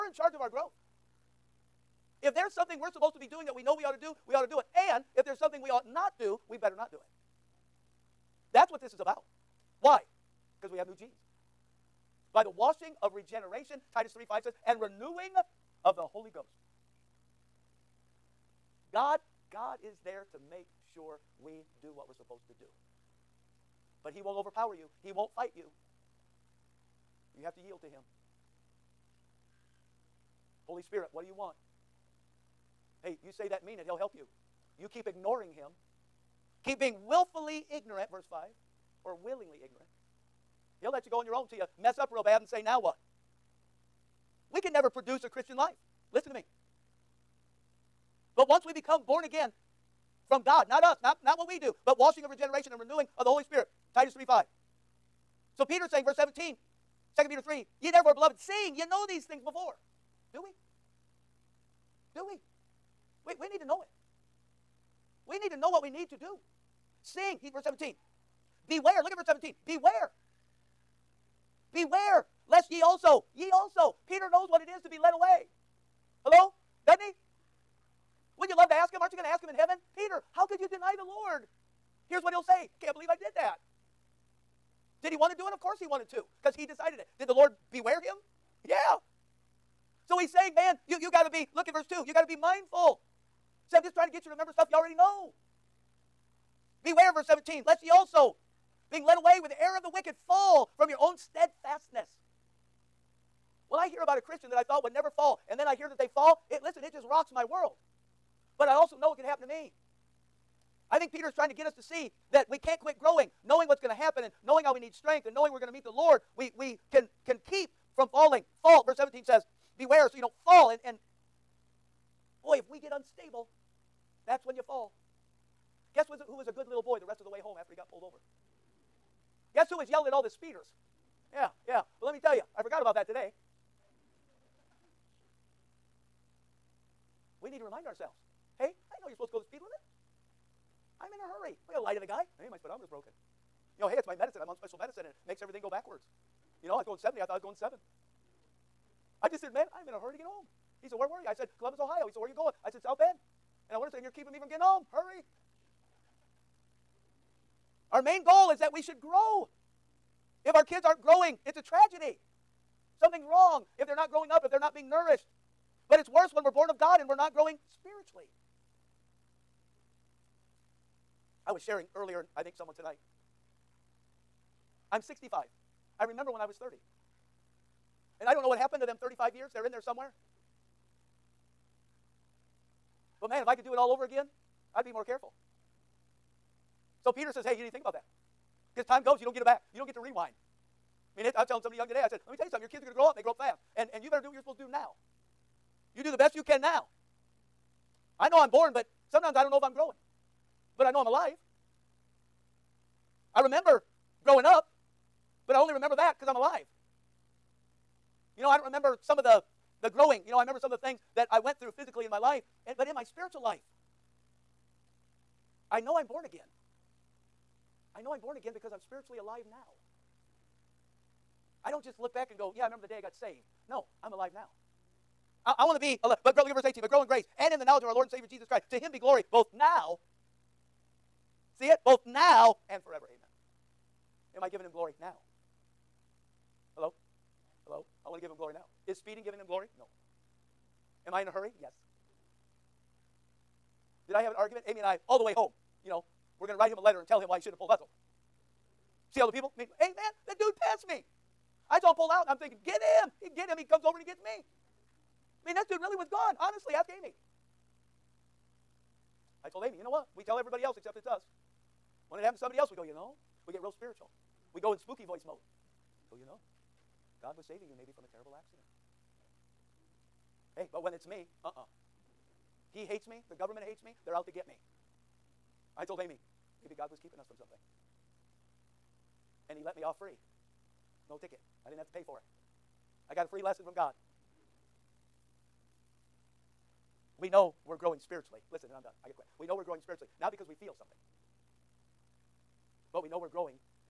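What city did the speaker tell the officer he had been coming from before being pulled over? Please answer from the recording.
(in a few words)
Columbus, Ohio.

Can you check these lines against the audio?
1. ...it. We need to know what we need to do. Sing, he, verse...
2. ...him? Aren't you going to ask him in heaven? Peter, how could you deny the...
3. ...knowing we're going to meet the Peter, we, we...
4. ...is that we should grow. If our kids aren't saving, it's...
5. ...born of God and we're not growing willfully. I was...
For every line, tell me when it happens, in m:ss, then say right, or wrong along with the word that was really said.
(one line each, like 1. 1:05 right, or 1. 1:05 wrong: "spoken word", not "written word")
1. 1:03 right
2. 1:18 right
3. 1:55 wrong: "Lord", not "Peter"
4. 2:38 wrong: "growing", not "saving"
5. 2:46 wrong: "spiritually", not "willfully".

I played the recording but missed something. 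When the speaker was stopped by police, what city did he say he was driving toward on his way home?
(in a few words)
South Bend.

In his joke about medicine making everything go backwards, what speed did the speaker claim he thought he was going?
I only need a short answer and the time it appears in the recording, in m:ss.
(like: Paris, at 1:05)
7, at 2:27.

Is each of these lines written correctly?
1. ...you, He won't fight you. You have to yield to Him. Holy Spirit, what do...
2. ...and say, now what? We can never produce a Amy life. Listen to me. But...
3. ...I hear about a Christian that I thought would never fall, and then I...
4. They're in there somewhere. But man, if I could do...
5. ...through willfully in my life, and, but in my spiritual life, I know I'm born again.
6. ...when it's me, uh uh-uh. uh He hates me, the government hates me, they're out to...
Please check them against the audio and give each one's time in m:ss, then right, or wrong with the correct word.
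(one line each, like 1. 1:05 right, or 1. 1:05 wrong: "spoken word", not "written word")
1. 0:24 right
2. 0:42 wrong: "Christian", not "Amy"
3. 1:43 right
4. 2:59 right
5. 3:31 wrong: "physically", not "willfully"
6. 4:30 right.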